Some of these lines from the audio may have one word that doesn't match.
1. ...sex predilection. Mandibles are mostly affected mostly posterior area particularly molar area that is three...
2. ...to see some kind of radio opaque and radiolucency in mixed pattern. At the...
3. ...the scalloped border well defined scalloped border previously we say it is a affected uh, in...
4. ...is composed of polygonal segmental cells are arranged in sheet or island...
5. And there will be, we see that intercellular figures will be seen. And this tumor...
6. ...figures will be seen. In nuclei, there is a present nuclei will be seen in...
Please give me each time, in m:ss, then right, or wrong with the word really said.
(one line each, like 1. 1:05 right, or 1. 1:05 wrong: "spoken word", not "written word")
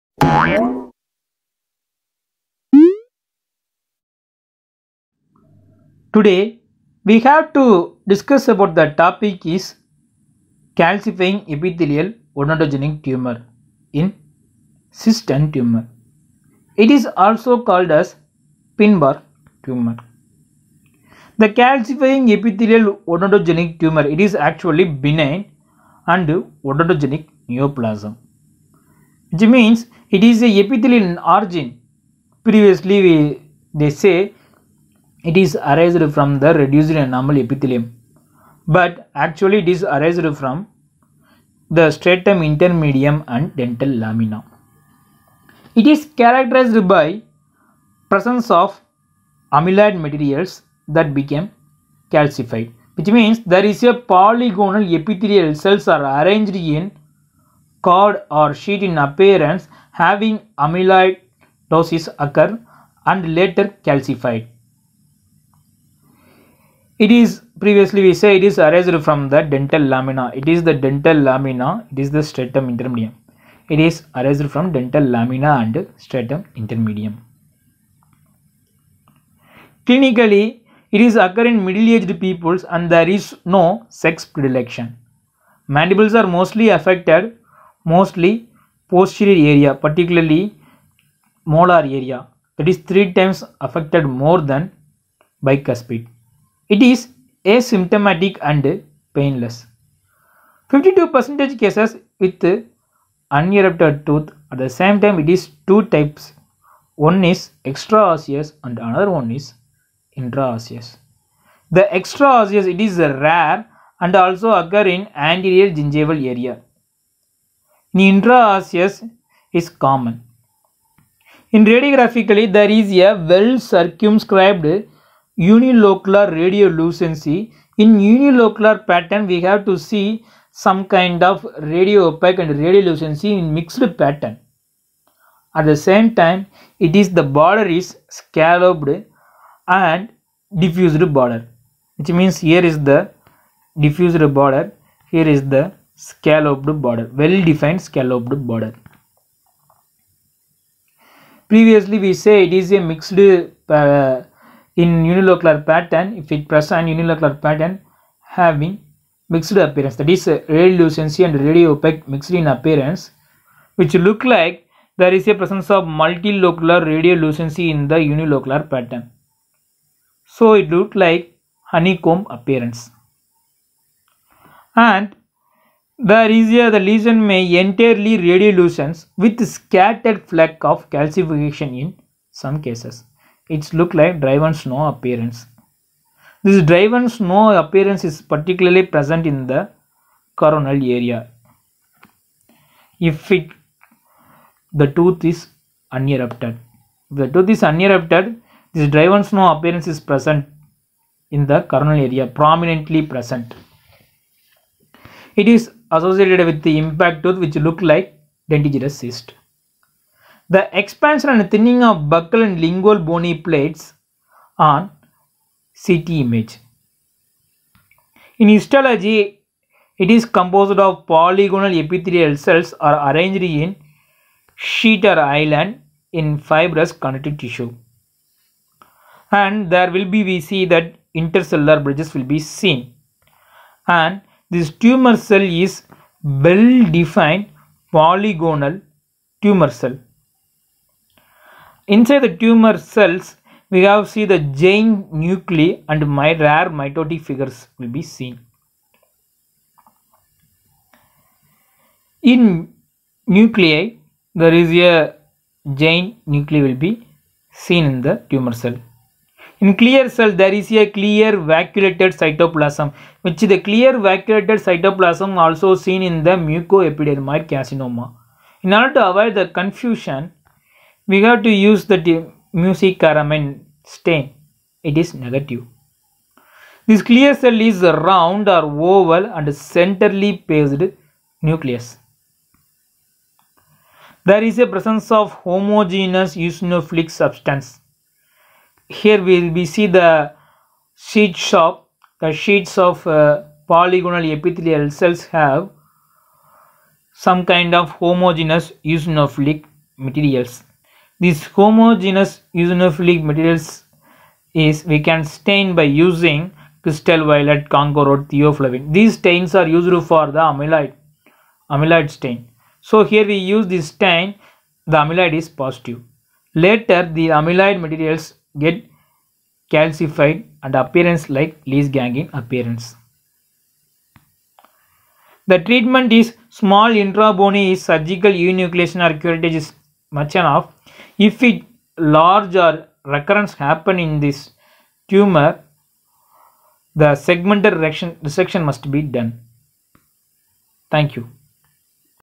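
1. 1:23 right
2. 2:09 right
3. 2:25 wrong: "mixed", not "affected"
4. 3:40 wrong: "epithelial", not "segmental"
5. 3:49 wrong: "bridges", not "figures"
6. 4:07 wrong: "giant", not "present".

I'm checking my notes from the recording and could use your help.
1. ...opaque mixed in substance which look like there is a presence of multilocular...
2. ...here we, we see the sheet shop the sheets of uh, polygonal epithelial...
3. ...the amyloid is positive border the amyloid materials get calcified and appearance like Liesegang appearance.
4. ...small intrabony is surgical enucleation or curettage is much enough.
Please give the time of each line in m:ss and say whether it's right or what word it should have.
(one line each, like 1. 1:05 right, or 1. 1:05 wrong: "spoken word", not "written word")
1. 2:41 wrong: "appearance", not "substance"
2. 4:48 right
3. 5:14 wrong: "later", not "border"
4. 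5:26 right.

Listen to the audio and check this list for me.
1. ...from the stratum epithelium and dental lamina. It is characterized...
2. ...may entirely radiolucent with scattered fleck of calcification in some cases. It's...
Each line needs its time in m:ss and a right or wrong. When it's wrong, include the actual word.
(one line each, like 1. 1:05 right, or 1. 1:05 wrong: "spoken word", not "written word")
1. 0:40 wrong: "intermedium", not "epithelium"
2. 2:57 right.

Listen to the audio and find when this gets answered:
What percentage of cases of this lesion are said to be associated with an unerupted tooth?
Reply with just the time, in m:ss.
1:40.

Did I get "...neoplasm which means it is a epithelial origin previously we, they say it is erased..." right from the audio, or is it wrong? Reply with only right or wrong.
wrong.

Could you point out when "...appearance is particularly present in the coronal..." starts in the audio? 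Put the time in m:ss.
3:07.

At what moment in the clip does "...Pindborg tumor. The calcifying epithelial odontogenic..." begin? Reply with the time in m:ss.
0:18.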